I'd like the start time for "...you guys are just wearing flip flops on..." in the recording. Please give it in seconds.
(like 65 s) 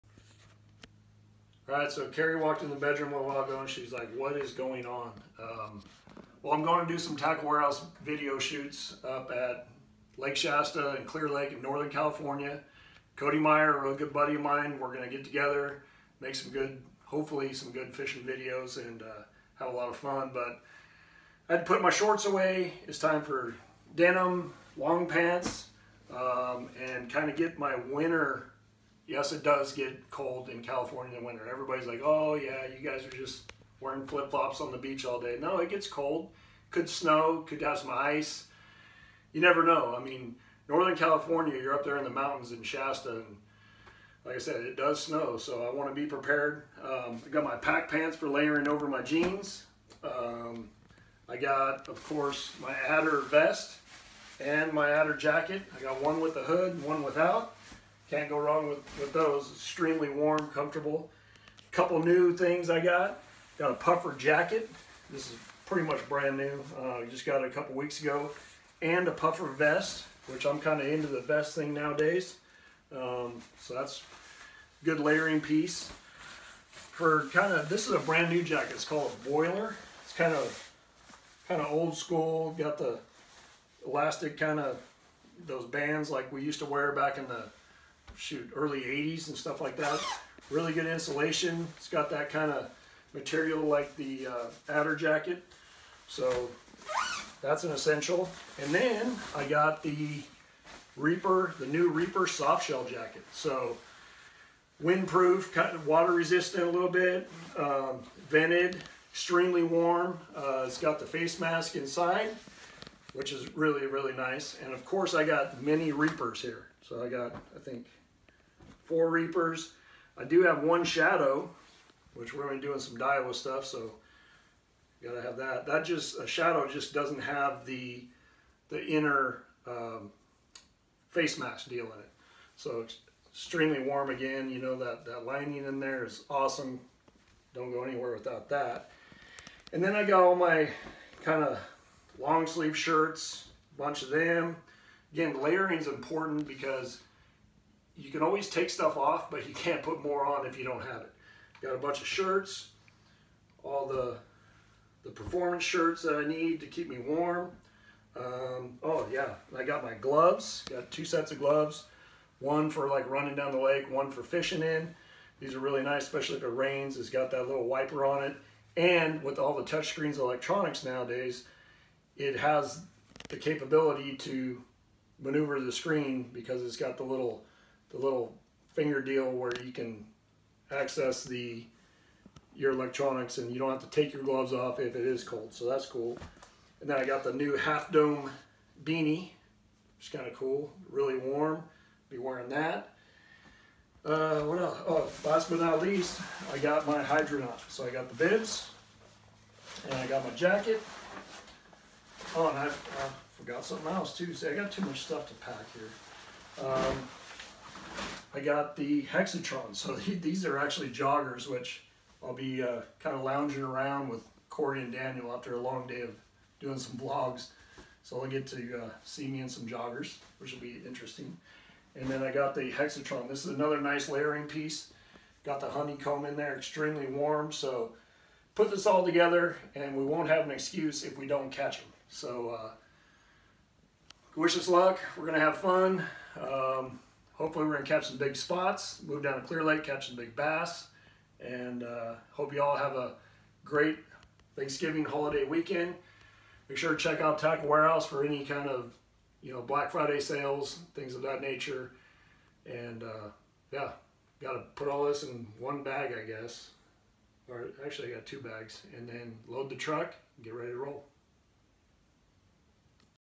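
32 s.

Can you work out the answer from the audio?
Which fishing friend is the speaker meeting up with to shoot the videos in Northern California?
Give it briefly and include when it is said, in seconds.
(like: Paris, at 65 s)
Cody Meyer, at 13 s.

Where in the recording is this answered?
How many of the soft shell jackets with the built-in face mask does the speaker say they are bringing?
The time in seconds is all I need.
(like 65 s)
118 s.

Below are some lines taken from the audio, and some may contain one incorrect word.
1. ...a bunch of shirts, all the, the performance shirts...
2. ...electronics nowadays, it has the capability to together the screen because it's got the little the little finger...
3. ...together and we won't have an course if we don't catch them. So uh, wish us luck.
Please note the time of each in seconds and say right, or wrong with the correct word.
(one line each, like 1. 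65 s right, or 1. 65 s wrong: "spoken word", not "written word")
1. 151 s right
2. 170 s wrong: "maneuver", not "together"
3. 229 s wrong: "excuse", not "course".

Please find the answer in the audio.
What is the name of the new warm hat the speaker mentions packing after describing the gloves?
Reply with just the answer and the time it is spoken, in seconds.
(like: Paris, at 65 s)
Half Dome beanie, at 187 s.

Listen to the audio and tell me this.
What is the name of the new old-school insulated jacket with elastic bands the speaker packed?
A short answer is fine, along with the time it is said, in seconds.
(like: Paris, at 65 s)
Boiler, at 79 s.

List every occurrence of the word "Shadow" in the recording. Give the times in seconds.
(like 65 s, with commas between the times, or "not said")
120 s, 126 s.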